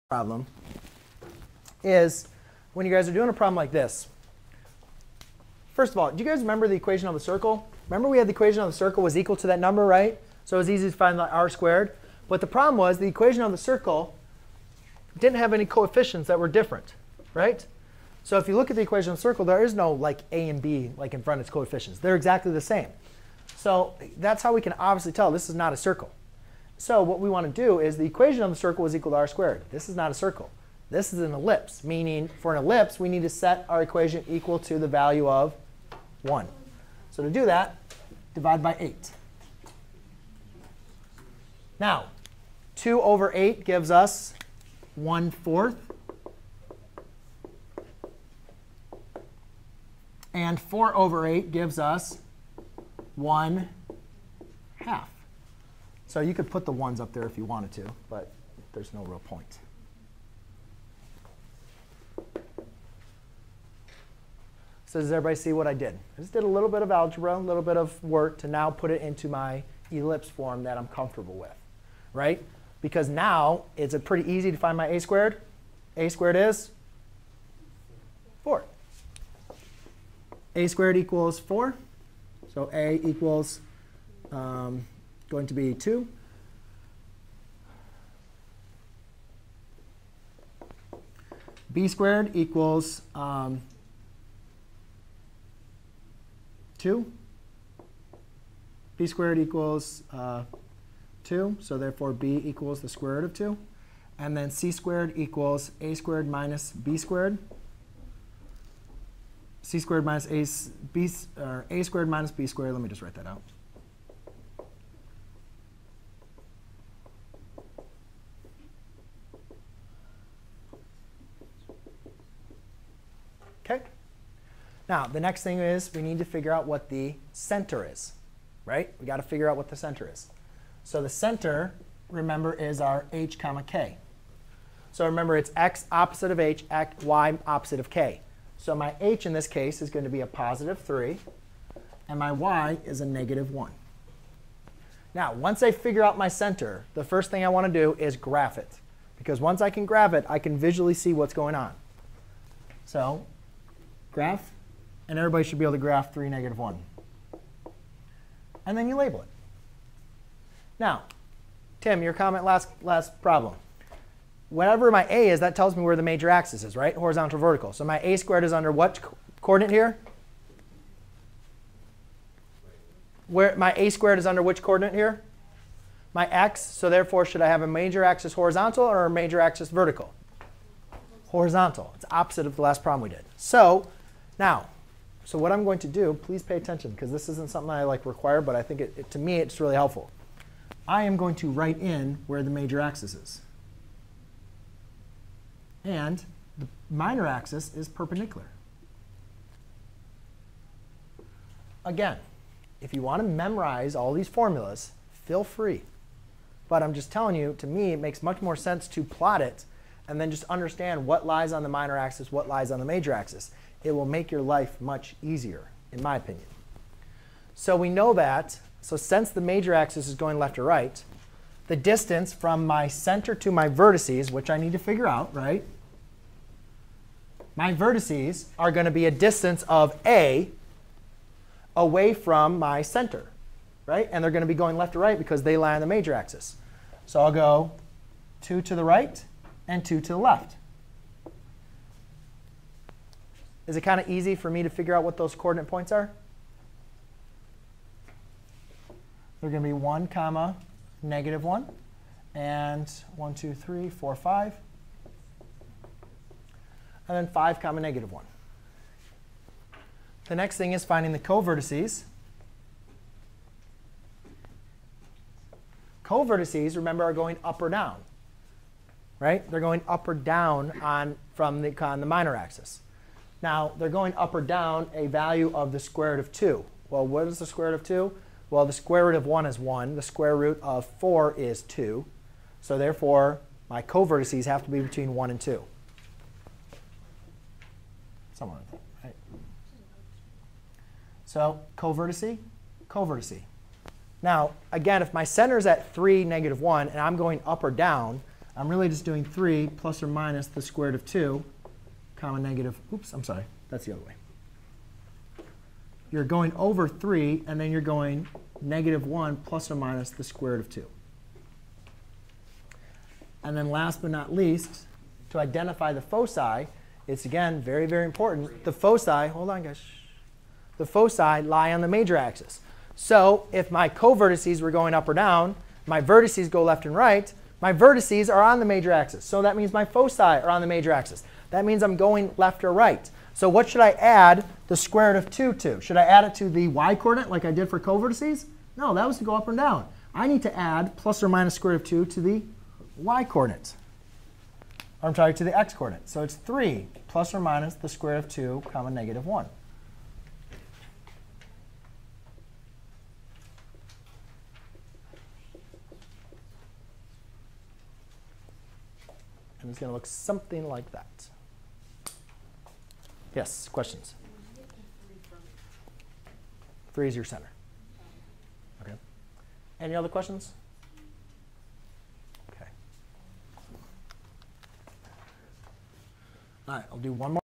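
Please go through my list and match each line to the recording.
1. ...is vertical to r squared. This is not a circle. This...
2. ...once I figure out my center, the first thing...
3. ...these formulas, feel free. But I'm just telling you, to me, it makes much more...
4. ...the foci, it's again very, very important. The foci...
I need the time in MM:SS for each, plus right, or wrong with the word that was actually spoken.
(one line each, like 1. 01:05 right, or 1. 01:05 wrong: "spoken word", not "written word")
1. 00:28 wrong: "equal", not "vertical"
2. 02:25 right
3. 03:24 right
4. 05:15 right.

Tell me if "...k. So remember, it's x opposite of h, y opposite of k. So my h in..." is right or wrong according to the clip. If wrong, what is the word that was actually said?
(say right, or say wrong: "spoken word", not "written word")
right.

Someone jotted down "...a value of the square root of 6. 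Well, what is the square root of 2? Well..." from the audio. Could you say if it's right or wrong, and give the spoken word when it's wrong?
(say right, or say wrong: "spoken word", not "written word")
wrong: "2", not "6".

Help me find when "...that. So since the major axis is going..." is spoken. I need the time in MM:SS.
03:38.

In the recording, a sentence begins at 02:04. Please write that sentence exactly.
Now, the next thing is we need to figure out what the center is, right?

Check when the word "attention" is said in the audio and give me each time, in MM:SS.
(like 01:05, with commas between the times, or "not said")
03:06.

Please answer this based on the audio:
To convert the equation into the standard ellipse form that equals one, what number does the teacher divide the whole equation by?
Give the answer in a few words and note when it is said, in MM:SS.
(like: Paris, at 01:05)
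8, at 00:38.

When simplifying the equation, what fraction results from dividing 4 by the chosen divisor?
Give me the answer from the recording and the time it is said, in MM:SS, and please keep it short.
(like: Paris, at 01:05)
1/2, at 00:53.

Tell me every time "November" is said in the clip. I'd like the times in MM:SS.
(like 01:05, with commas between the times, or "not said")
not said.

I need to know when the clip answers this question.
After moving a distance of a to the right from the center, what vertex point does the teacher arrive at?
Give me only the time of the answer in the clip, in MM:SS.
04:17.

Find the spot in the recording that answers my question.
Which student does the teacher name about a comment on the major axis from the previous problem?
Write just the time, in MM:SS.
02:41.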